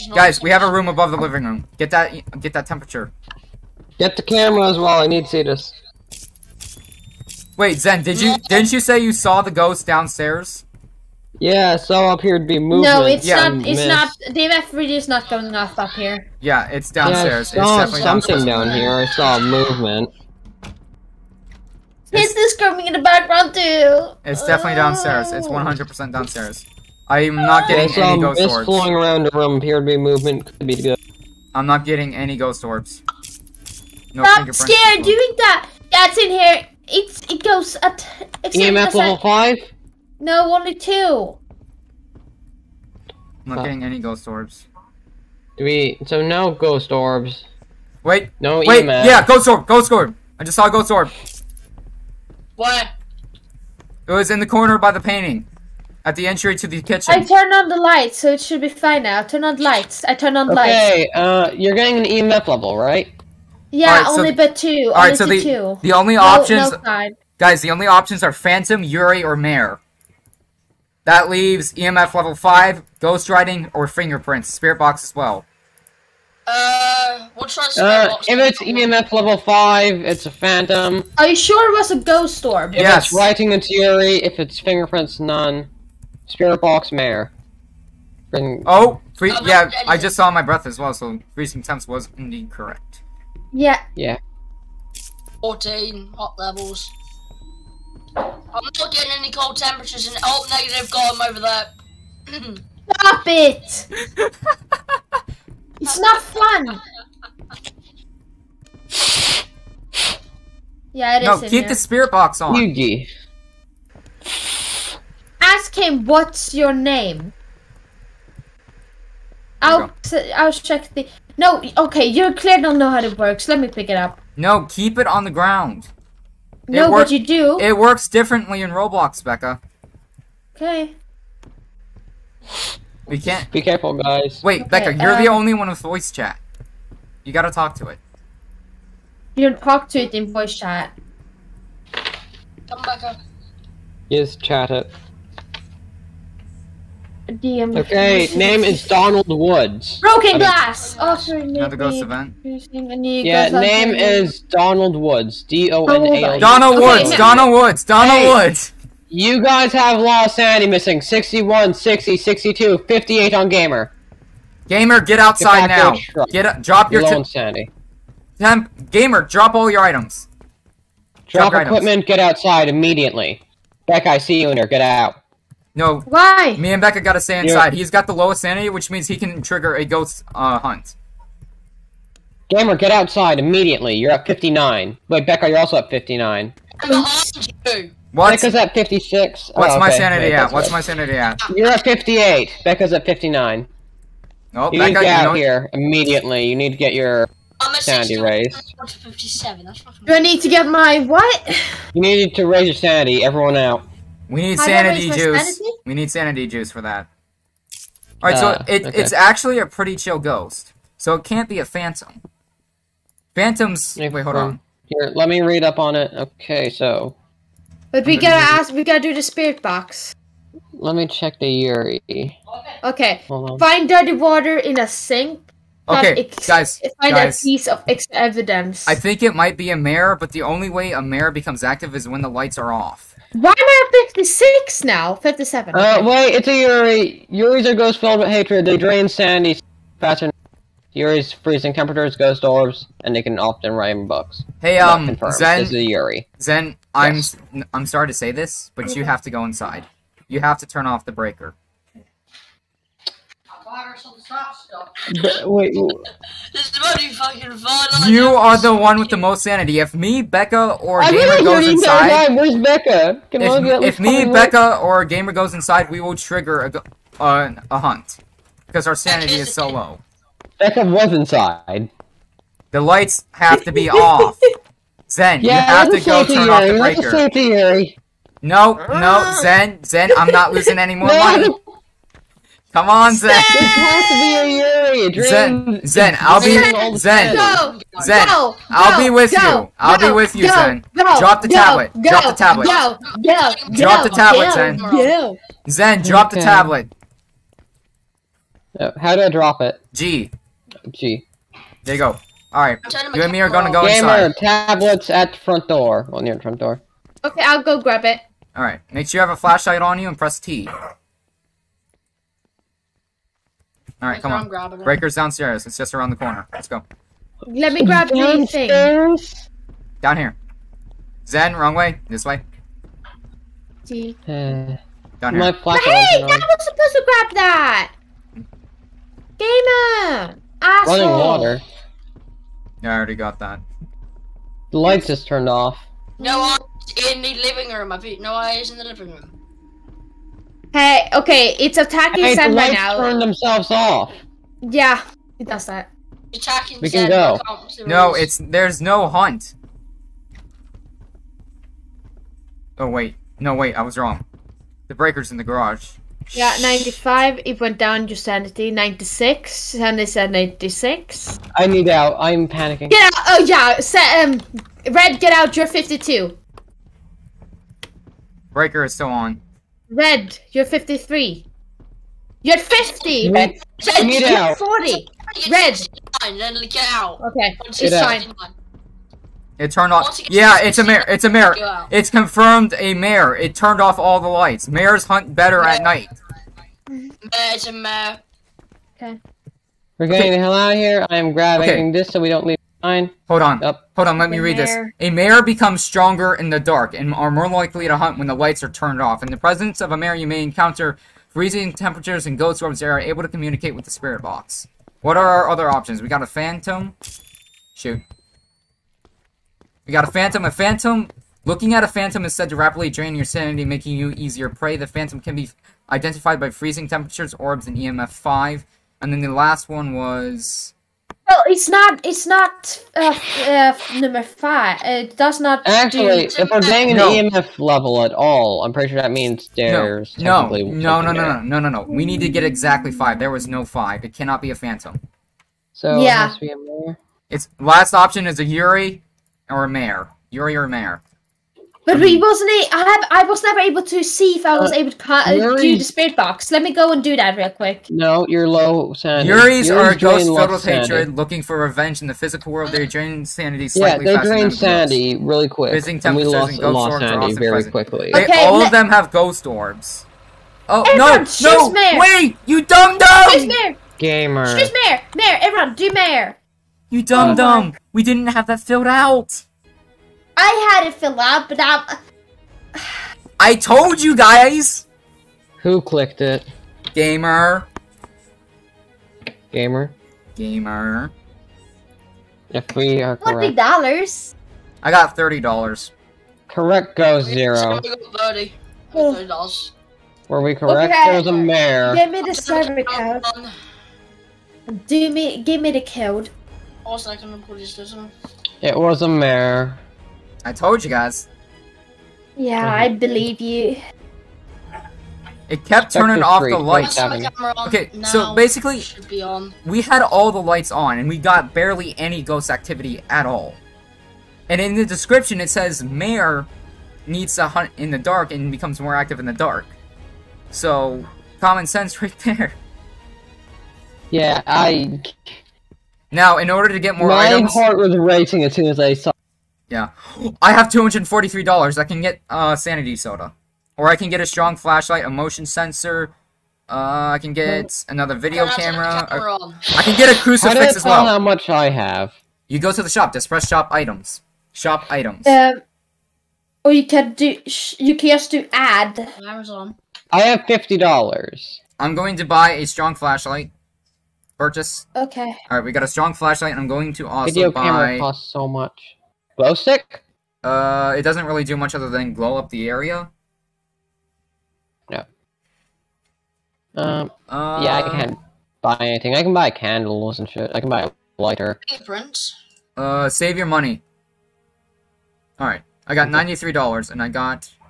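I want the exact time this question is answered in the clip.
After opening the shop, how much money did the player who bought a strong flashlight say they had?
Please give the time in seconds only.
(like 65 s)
550 s.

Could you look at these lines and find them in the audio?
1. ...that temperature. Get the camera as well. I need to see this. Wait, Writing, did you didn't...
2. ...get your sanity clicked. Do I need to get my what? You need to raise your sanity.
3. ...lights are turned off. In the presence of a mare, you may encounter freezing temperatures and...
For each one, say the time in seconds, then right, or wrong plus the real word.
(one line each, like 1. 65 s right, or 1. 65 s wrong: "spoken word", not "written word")
1. 2 s wrong: "Zen", not "Writing"
2. 196 s wrong: "raised", not "clicked"
3. 398 s right.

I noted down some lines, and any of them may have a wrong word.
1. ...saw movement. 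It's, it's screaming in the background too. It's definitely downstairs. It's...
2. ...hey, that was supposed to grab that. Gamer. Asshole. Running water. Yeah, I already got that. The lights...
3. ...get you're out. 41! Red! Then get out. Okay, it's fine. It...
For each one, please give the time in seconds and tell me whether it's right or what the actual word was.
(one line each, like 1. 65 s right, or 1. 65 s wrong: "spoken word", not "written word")
1. 19 s right
2. 325 s right
3. 373 s wrong: "40", not "41".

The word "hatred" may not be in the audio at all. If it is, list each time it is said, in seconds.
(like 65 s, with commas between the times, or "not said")
238 s, 450 s.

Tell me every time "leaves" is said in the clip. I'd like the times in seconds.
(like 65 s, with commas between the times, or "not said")
71 s, 392 s.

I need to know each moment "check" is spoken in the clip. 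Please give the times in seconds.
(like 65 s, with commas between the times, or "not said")
120 s, 221 s.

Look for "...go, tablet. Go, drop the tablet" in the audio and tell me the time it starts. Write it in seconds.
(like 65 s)
291 s.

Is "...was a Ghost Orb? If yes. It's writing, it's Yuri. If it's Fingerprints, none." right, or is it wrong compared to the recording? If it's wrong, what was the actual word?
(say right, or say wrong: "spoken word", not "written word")
right.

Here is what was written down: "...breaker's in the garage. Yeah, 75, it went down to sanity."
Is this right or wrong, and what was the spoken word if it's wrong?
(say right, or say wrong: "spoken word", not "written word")
wrong: "95", not "75".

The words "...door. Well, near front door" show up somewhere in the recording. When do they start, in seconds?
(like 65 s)
305 s.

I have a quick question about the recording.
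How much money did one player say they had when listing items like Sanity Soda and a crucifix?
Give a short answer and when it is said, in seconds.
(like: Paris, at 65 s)
$243, at 530 s.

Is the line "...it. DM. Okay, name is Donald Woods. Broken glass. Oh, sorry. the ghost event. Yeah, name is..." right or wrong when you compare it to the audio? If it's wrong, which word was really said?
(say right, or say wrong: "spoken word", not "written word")
right.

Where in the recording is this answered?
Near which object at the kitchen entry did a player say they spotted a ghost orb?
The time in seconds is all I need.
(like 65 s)
54 s.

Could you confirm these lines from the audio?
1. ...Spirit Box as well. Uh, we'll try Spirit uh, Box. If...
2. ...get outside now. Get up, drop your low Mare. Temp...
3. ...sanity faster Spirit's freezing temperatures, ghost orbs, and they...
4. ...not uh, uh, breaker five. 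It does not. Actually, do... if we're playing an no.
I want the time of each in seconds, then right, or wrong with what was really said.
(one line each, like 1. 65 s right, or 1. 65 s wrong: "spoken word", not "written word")
1. 74 s right
2. 165 s wrong: "Sandy", not "Mare"
3. 239 s wrong: "Yuri", not "Spirit"
4. 422 s wrong: "number", not "breaker".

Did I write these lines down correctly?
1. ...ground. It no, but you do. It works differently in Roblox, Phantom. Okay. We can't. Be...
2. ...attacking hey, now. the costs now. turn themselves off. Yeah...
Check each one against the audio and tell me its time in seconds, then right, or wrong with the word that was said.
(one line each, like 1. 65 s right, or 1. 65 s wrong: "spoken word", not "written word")
1. 125 s wrong: "Becca", not "Phantom"
2. 341 s wrong: "lights", not "costs".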